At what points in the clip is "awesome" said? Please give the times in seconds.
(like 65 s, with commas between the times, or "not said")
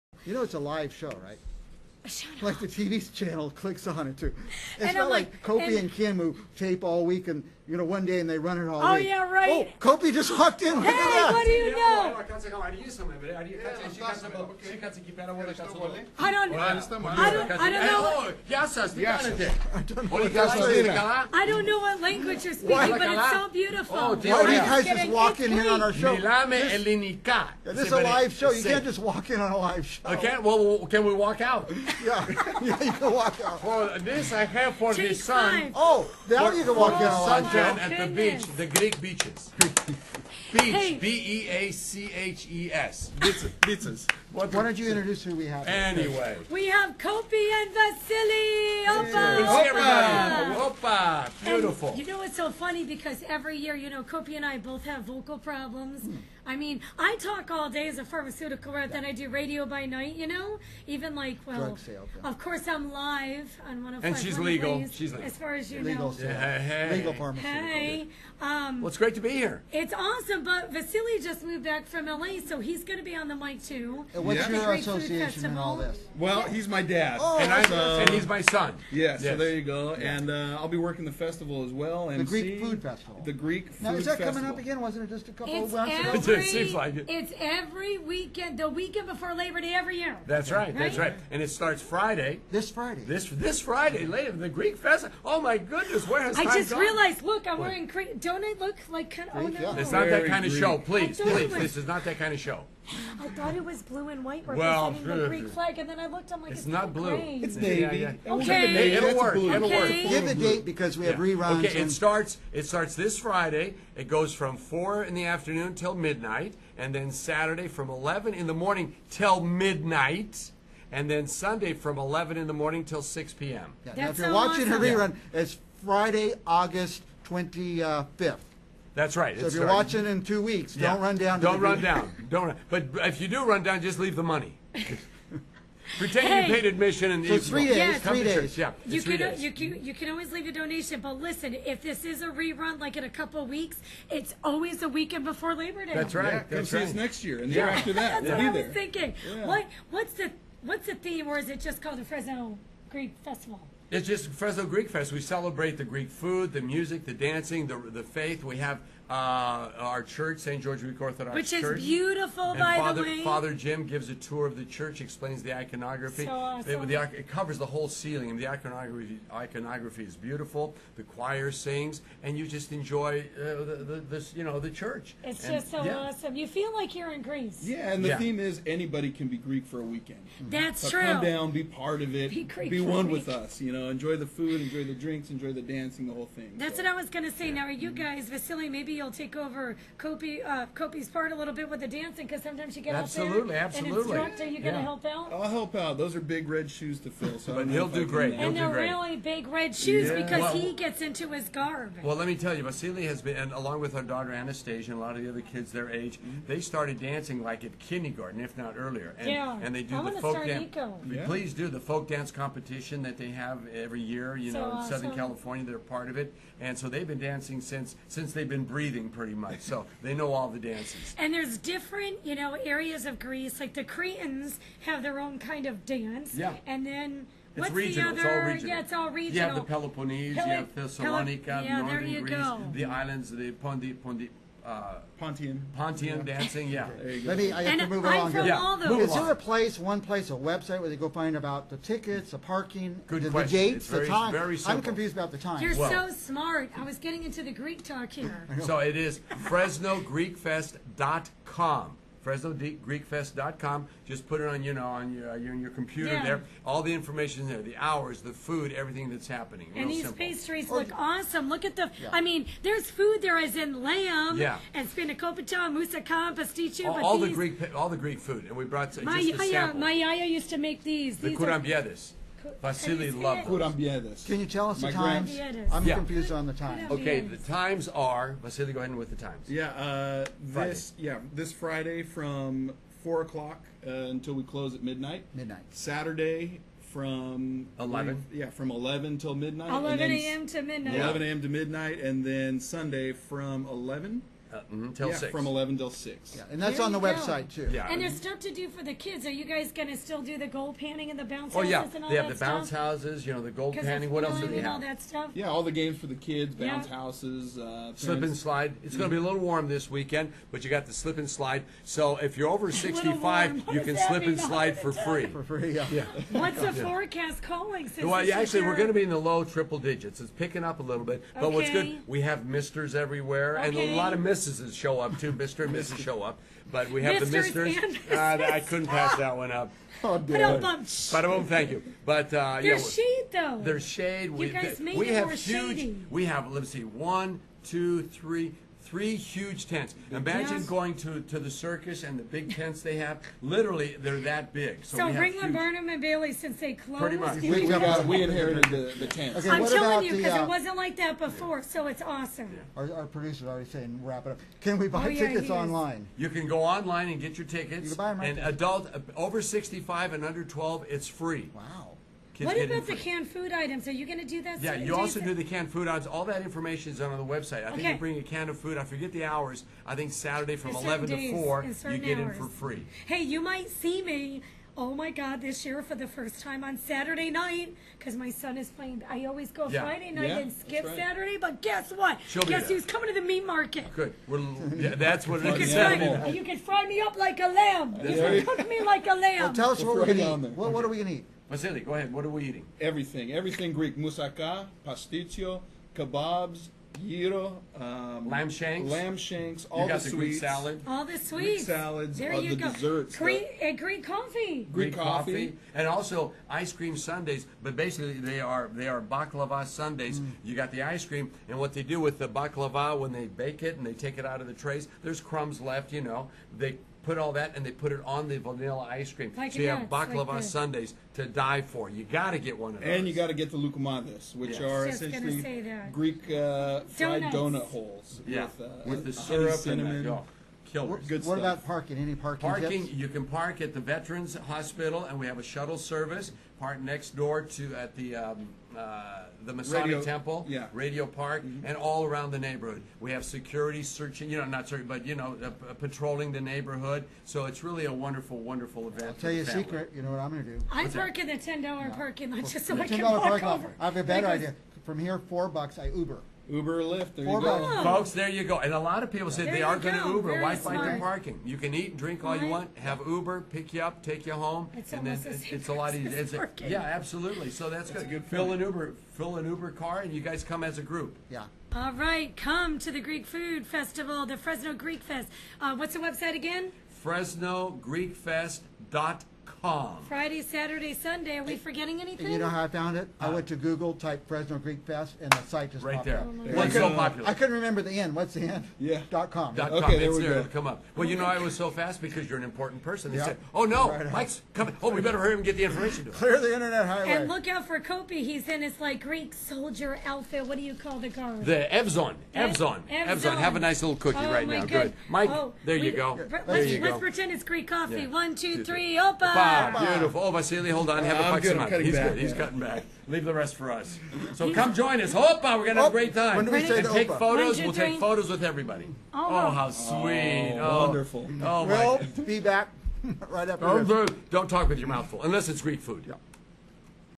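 69 s, 124 s, 166 s, 175 s, 214 s, 260 s, 352 s.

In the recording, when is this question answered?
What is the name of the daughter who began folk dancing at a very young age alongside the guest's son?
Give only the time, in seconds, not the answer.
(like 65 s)
204 s.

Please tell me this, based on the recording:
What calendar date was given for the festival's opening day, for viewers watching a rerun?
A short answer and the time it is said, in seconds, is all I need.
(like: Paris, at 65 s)
Friday, August 25th, at 126 s.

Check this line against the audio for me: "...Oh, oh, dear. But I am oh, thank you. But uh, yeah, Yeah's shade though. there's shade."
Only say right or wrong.
wrong.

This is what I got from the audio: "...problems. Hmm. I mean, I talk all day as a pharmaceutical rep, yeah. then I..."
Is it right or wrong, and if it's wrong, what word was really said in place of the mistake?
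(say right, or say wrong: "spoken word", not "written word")
right.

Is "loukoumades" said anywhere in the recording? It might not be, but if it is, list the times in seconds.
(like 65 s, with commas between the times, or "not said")
423 s.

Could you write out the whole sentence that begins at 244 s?
Very I'm confused about the time.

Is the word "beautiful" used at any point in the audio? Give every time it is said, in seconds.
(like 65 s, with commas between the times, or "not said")
23 s, 51 s, 161 s, 170 s, 509 s.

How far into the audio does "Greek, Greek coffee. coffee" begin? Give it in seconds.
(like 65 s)
404 s.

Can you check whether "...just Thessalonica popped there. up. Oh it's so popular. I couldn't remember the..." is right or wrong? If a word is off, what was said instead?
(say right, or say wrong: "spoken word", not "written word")
wrong: "Right", not "Thessalonica".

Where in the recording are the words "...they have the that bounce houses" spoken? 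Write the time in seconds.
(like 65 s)
302 s.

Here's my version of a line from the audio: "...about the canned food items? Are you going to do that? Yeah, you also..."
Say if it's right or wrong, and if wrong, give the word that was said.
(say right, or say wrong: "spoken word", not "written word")
right.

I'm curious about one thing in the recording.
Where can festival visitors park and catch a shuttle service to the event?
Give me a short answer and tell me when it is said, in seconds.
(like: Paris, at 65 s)
Veterans Hospital, at 433 s.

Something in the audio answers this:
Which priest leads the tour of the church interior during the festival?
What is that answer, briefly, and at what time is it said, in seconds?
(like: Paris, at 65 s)
Father Jim, at 163 s.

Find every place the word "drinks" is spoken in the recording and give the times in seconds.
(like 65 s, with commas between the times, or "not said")
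184 s, 461 s.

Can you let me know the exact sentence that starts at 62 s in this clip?
of course I'm live on one of And she's legal.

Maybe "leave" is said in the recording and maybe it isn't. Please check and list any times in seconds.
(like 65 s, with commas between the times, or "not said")
133 s, 140 s, 513 s.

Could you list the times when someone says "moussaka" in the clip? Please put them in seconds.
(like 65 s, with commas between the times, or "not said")
265 s, 393 s.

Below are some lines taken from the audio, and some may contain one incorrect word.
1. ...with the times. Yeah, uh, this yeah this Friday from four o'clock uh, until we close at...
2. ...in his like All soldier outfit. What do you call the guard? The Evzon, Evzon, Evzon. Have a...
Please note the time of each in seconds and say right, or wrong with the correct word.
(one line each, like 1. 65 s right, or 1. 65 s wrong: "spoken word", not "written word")
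1. 278 s right
2. 498 s wrong: "Greek", not "All".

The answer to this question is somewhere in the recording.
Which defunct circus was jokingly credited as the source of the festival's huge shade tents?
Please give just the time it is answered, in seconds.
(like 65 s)
345 s.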